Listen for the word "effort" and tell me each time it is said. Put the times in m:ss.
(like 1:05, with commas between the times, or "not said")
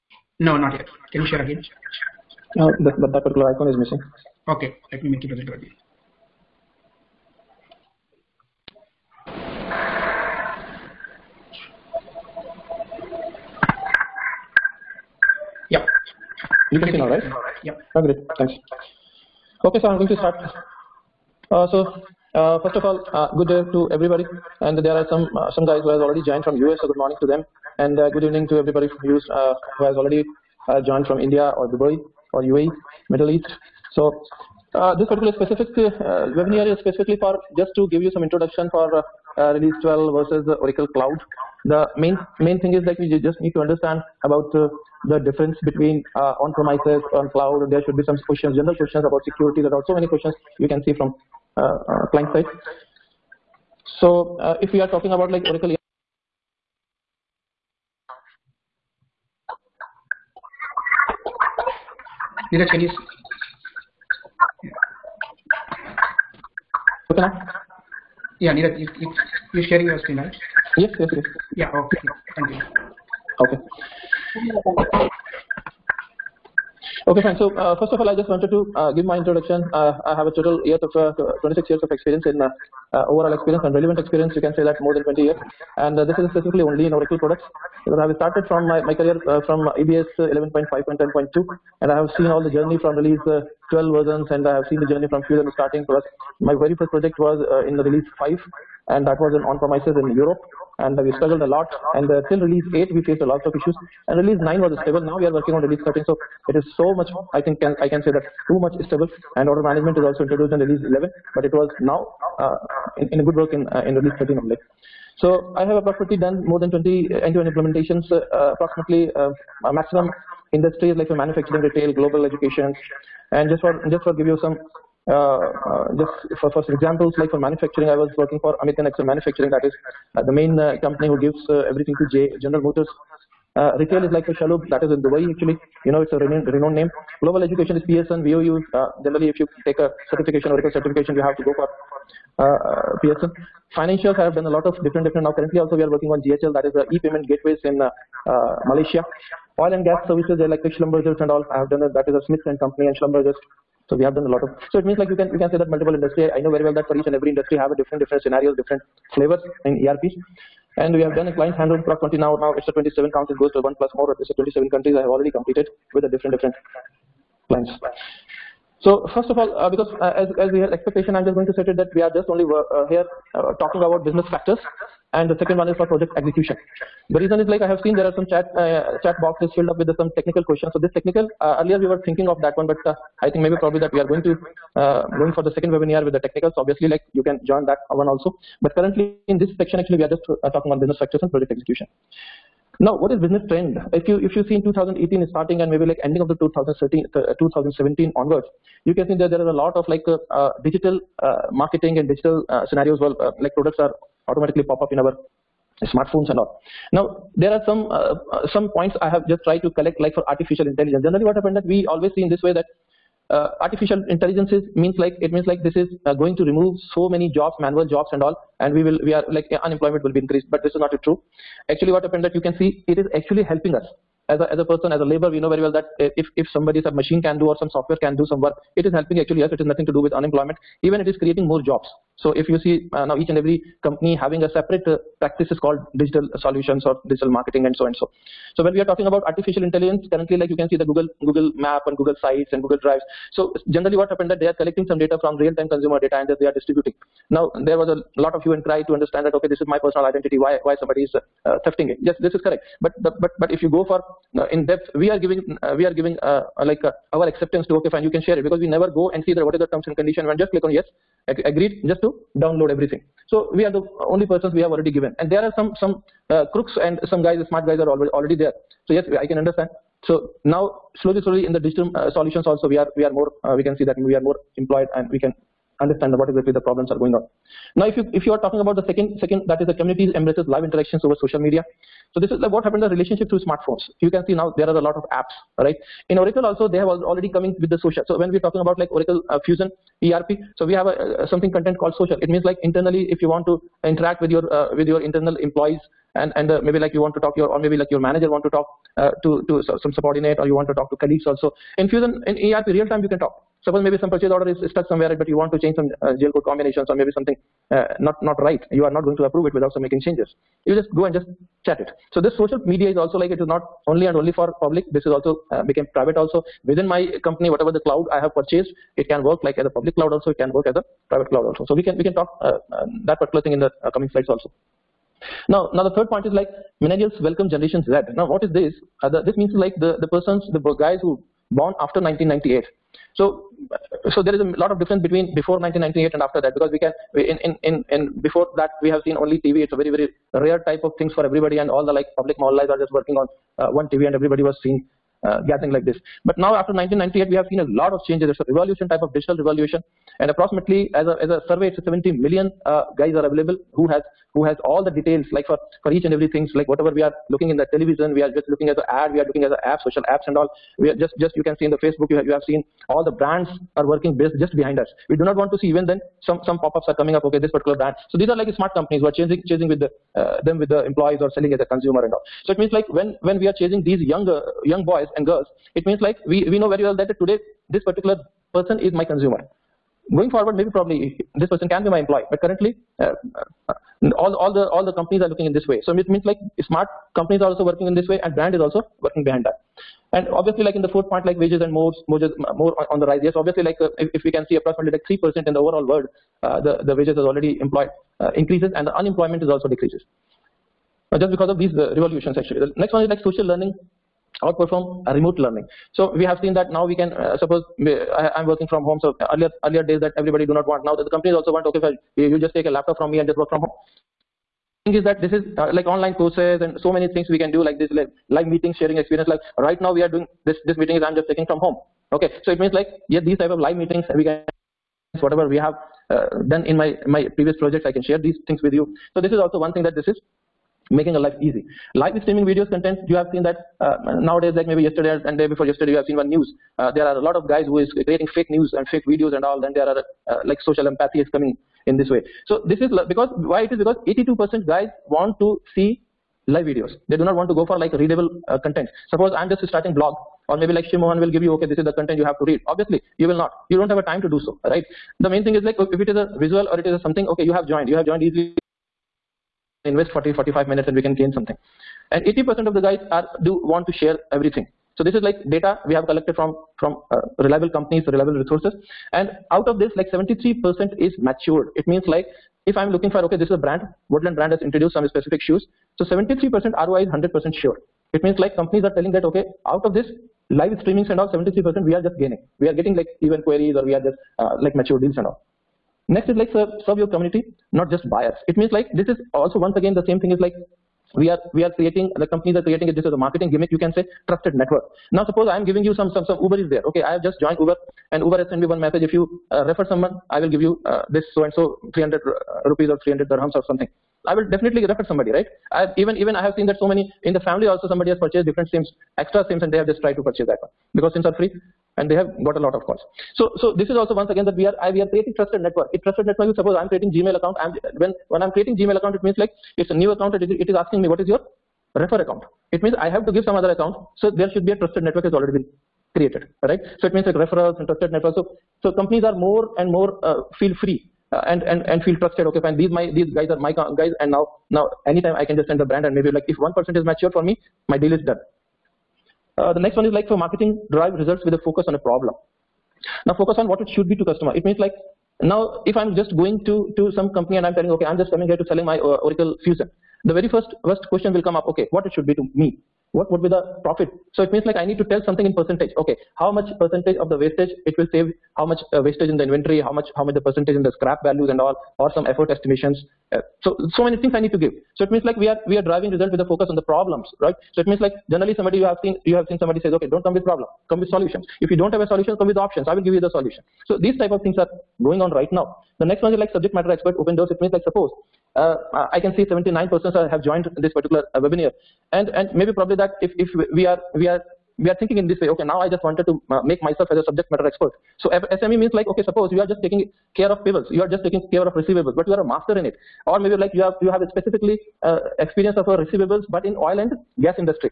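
9:22.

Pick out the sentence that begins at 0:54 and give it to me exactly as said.
So uh, if we are talking about like Oracle Neeraj, can you?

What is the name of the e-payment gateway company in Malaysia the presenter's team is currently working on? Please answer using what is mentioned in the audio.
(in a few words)
GHL.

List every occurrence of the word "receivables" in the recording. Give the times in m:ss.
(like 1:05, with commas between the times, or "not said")
9:51, 9:55.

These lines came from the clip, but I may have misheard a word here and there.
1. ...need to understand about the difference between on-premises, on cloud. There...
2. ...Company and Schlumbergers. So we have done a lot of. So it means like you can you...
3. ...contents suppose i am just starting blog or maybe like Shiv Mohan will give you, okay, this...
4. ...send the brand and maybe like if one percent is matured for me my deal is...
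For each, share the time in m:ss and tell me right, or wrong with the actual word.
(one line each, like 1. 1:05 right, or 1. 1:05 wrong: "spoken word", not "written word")
1. 0:43 right
2. 2:32 right
3. 7:28 right
4. 8:55 right.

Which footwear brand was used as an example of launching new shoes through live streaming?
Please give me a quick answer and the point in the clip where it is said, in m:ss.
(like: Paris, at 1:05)
Woodland, at 7:54.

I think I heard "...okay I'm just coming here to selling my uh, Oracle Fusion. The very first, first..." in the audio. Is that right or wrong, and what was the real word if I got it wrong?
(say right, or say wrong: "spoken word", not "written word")
right.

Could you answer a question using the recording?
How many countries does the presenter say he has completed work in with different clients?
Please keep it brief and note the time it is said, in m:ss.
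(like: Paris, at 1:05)
27, at 2:44.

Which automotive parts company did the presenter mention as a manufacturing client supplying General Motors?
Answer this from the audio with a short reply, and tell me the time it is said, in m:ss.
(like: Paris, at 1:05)
American Axle Manufacturing, at 2:08.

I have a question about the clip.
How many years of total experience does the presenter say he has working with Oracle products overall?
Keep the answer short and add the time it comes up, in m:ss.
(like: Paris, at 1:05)
26, at 1:21.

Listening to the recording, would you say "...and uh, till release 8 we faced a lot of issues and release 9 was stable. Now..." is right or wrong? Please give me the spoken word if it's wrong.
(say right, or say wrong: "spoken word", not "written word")
right.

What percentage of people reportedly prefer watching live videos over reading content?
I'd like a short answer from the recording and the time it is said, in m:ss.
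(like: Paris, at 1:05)
82%, at 7:24.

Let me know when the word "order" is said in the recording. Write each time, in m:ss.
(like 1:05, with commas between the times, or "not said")
1:49, 5:04.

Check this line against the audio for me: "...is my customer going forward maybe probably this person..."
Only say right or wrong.
wrong.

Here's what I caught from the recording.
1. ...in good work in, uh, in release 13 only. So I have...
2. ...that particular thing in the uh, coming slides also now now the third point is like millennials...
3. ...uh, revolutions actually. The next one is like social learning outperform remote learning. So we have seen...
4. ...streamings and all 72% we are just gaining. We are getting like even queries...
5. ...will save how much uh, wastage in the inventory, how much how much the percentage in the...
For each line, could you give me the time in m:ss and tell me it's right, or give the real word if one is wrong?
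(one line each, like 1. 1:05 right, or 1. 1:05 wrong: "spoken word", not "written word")
1. 1:53 right
2. 5:23 right
3. 6:41 right
4. 8:00 wrong: "73", not "72"
5. 9:17 right.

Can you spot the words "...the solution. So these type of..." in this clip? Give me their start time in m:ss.
9:33.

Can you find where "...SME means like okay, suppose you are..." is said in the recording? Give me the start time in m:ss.
9:48.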